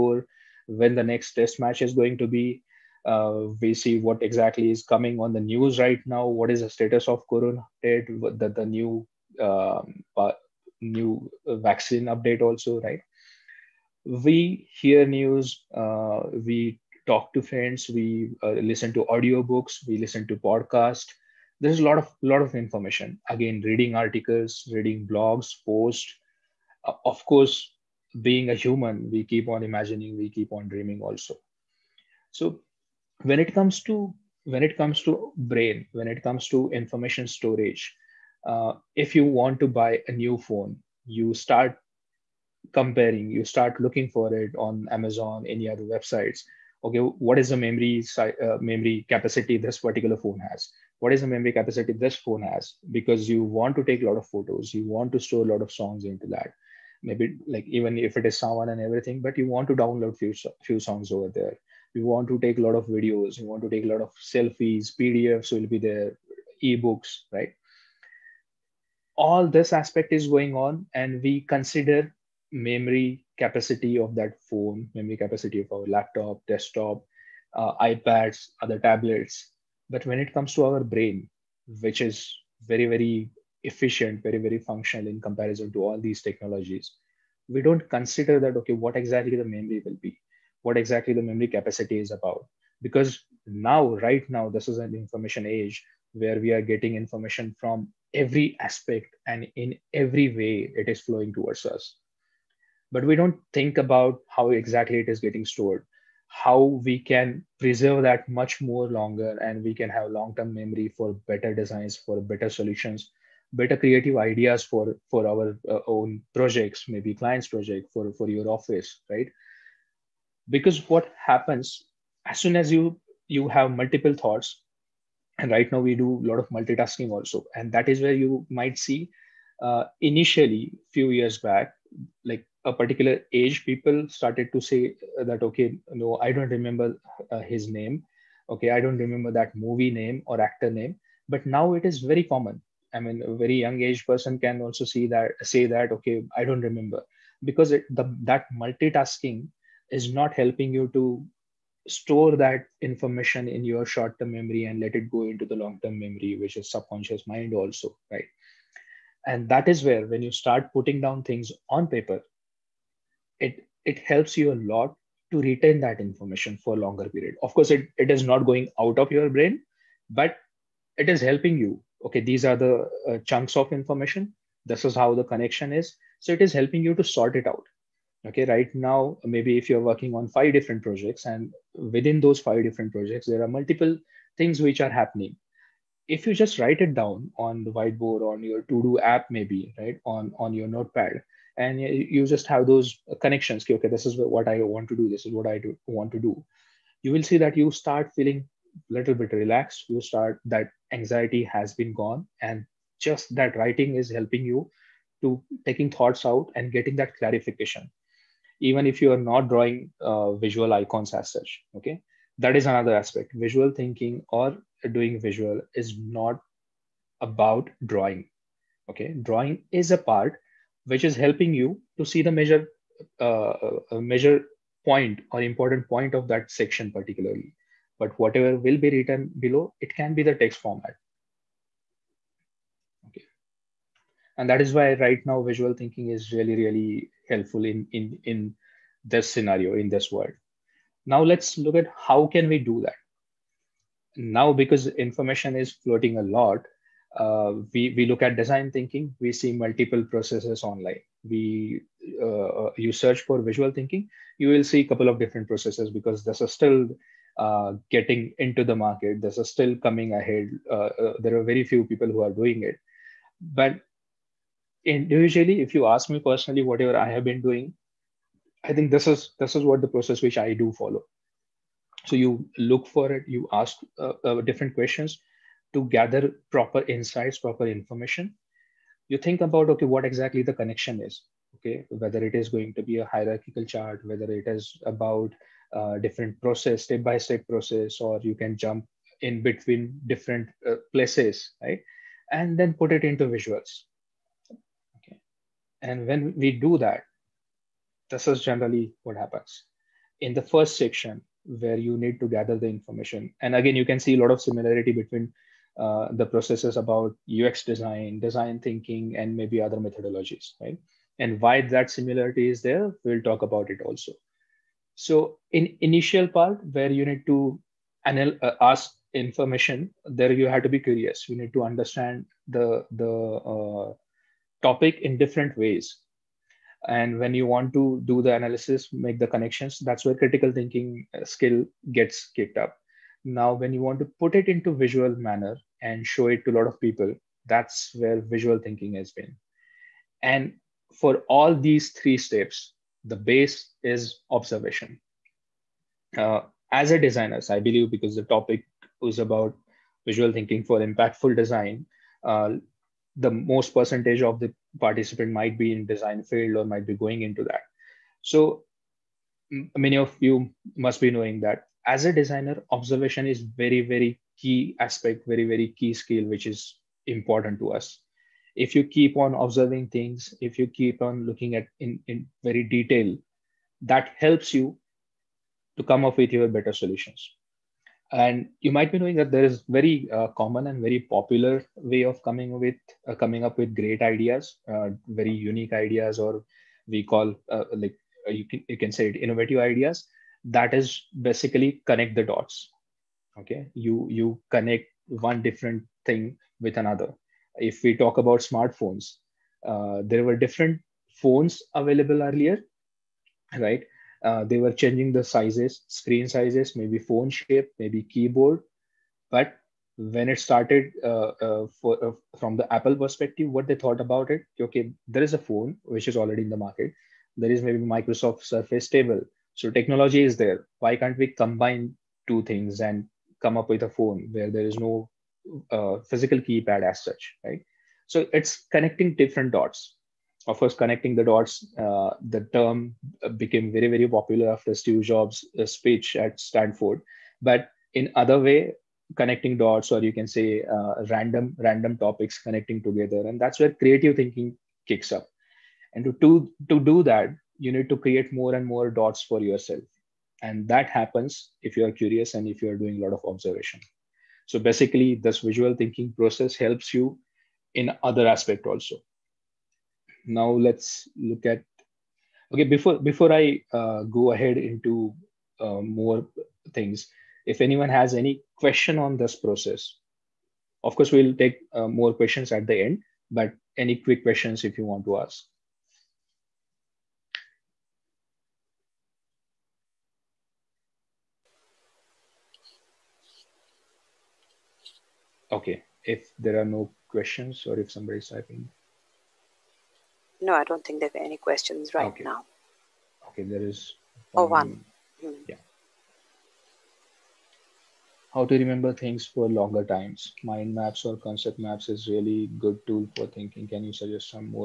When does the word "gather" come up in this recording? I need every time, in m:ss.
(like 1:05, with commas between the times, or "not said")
4:35, 5:02.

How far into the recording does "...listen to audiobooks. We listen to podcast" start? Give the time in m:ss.
0:18.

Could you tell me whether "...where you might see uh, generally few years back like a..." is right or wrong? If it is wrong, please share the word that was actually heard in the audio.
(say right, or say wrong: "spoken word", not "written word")
wrong: "initially", not "generally".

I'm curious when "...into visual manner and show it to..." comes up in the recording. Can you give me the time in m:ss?
5:34.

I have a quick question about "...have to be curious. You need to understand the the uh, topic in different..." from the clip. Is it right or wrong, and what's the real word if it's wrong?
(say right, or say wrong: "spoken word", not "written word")
right.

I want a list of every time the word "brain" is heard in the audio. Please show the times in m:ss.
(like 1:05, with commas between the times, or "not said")
0:35, 1:20, 2:49.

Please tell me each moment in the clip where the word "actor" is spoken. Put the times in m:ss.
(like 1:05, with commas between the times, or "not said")
2:20.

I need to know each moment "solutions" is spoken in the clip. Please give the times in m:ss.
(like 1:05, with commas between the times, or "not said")
1:52, 6:16.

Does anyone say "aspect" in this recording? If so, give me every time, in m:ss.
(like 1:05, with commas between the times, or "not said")
1:09, 1:38, 3:32, 6:04, 7:38.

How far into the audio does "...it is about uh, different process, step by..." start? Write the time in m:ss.
4:44.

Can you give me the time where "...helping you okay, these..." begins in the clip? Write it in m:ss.
2:51.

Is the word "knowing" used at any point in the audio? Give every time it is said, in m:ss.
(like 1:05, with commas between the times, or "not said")
6:01, 6:18.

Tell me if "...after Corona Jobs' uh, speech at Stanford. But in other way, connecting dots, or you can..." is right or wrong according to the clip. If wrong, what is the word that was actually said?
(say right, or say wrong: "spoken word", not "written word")
wrong: "Steve", not "Corona".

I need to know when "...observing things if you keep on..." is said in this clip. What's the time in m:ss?
6:09.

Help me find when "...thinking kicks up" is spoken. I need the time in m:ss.
7:24.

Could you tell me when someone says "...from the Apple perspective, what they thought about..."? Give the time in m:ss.
6:52.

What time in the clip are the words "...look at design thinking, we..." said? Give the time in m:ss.
4:08.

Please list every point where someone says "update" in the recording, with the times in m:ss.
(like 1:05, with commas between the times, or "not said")
0:07, 0:12.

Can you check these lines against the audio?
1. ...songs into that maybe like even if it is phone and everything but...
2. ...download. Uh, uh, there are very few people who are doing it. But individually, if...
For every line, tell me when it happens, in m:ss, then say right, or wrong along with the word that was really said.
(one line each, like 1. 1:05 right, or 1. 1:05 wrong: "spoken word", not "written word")
1. 0:55 wrong: "someone", not "phone"
2. 4:20 wrong: "ahead", not "download".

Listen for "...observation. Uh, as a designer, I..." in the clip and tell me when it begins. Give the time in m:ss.
5:44.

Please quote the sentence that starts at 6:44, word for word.
Uh, they were changing the sizes, screen sizes, maybe phone shape, maybe keyboard.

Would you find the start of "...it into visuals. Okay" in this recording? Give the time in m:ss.
4:52.